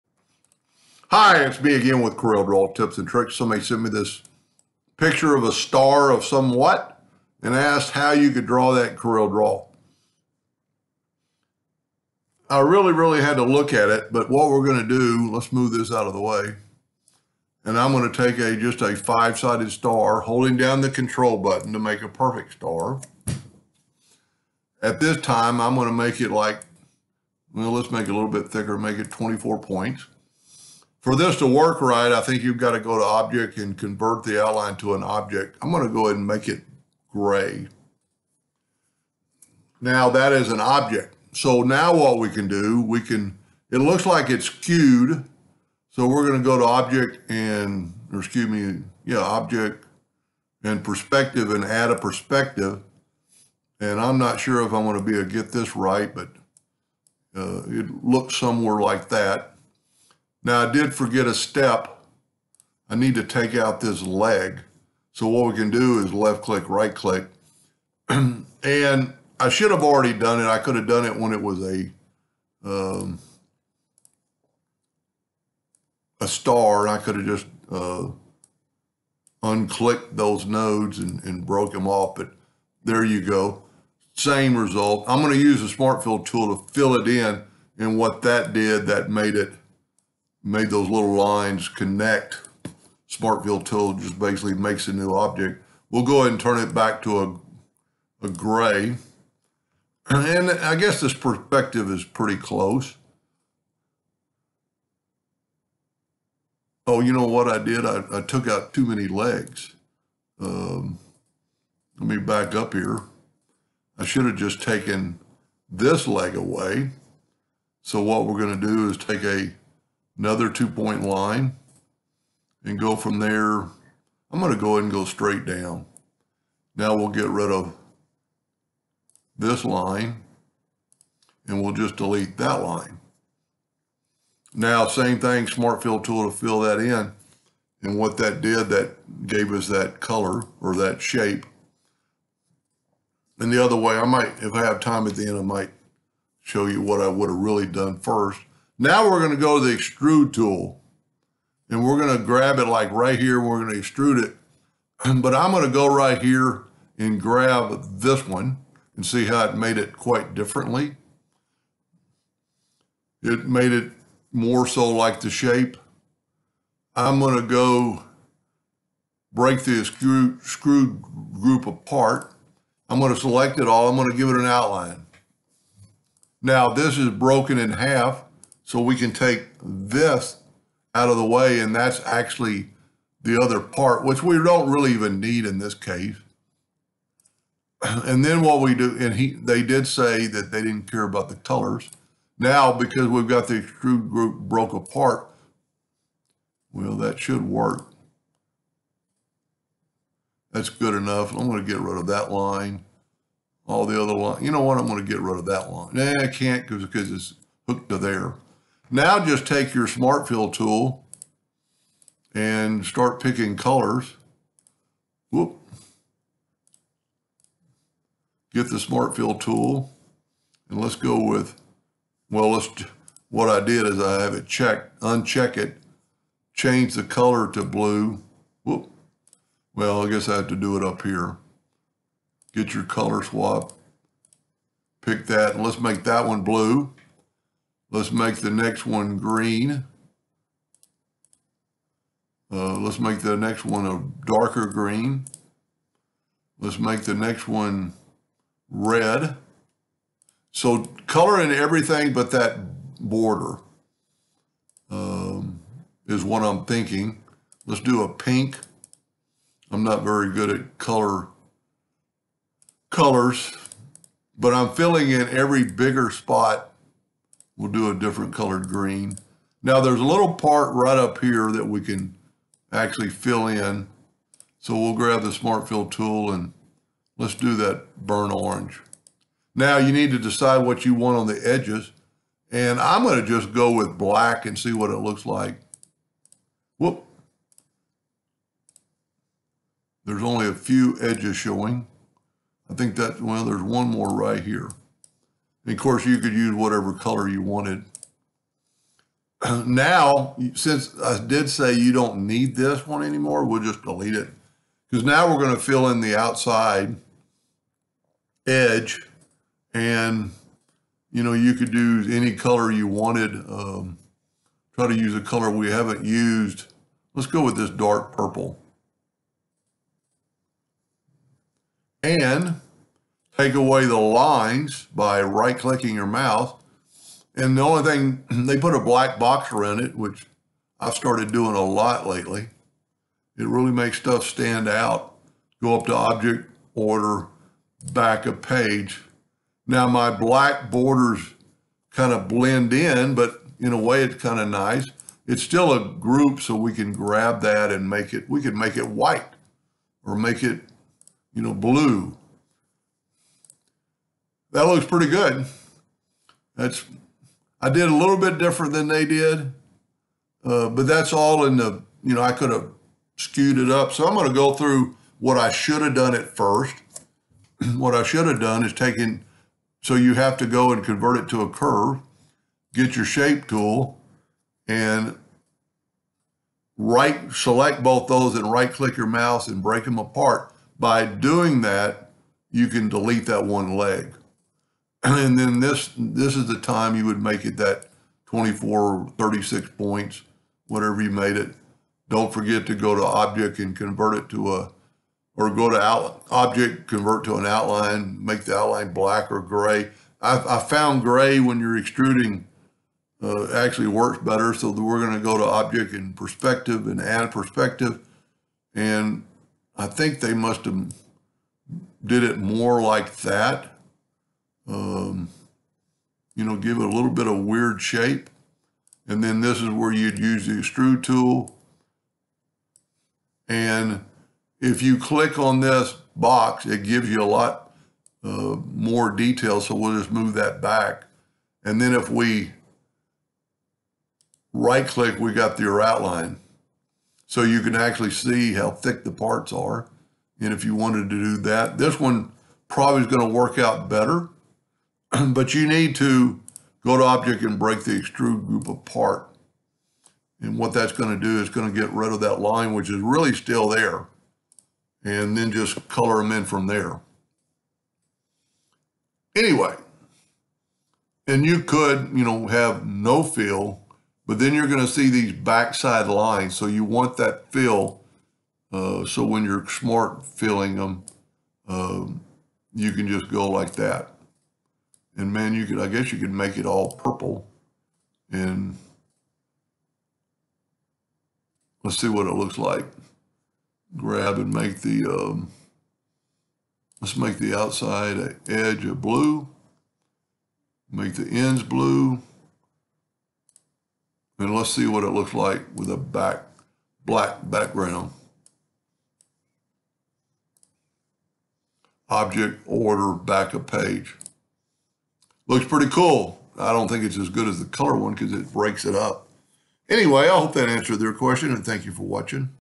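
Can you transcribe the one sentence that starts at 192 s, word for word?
Now, because we've got the extrude group broke apart, well, that should work.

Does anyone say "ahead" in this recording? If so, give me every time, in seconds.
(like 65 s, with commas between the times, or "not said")
36 s, 96 s, 124 s.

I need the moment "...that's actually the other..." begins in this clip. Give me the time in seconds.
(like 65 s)
181 s.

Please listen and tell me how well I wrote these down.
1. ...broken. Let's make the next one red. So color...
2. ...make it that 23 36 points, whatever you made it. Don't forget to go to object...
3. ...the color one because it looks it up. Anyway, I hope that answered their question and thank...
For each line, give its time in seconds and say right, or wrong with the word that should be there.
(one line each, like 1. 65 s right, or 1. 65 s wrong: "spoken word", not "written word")
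1. 244 s wrong: "green", not "broken"
2. 387 s wrong: "24", not "23"
3. 507 s wrong: "breaks", not "looks".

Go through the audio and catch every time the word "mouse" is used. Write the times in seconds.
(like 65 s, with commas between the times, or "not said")
326 s, 379 s.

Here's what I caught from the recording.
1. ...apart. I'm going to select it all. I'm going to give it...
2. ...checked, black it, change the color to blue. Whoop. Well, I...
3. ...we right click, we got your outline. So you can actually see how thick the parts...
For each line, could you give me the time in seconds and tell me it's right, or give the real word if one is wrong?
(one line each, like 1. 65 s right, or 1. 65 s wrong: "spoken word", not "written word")
1. 171 s right
2. 224 s wrong: "uncheck", not "black"
3. 432 s right.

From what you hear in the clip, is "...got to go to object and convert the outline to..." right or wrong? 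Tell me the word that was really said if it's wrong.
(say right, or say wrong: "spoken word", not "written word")
right.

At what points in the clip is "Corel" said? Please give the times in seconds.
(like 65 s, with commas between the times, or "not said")
2 s, 8 s.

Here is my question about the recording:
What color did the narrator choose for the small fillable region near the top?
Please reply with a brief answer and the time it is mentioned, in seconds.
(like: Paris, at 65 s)
burn orange, at 277 s.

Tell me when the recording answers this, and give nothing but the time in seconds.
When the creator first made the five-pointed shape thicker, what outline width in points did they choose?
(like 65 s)
29 s.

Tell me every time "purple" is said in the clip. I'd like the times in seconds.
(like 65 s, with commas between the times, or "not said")
318 s, 476 s.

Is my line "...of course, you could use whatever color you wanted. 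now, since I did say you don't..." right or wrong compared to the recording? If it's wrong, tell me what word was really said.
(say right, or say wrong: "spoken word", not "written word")
right.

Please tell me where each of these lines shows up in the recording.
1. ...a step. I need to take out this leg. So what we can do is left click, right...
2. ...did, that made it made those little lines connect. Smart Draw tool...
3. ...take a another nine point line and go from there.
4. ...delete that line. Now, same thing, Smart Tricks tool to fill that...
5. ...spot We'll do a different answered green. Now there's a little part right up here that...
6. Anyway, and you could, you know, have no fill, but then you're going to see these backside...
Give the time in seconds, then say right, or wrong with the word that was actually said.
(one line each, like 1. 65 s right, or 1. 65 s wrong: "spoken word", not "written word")
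1. 61 s right
2. 88 s wrong: "Fill", not "Draw"
3. 118 s wrong: "two", not "nine"
4. 131 s wrong: "Fill", not "Tricks"
5. 266 s wrong: "colored", not "answered"
6. 459 s right.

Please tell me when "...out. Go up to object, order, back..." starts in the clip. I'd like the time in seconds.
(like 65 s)
334 s.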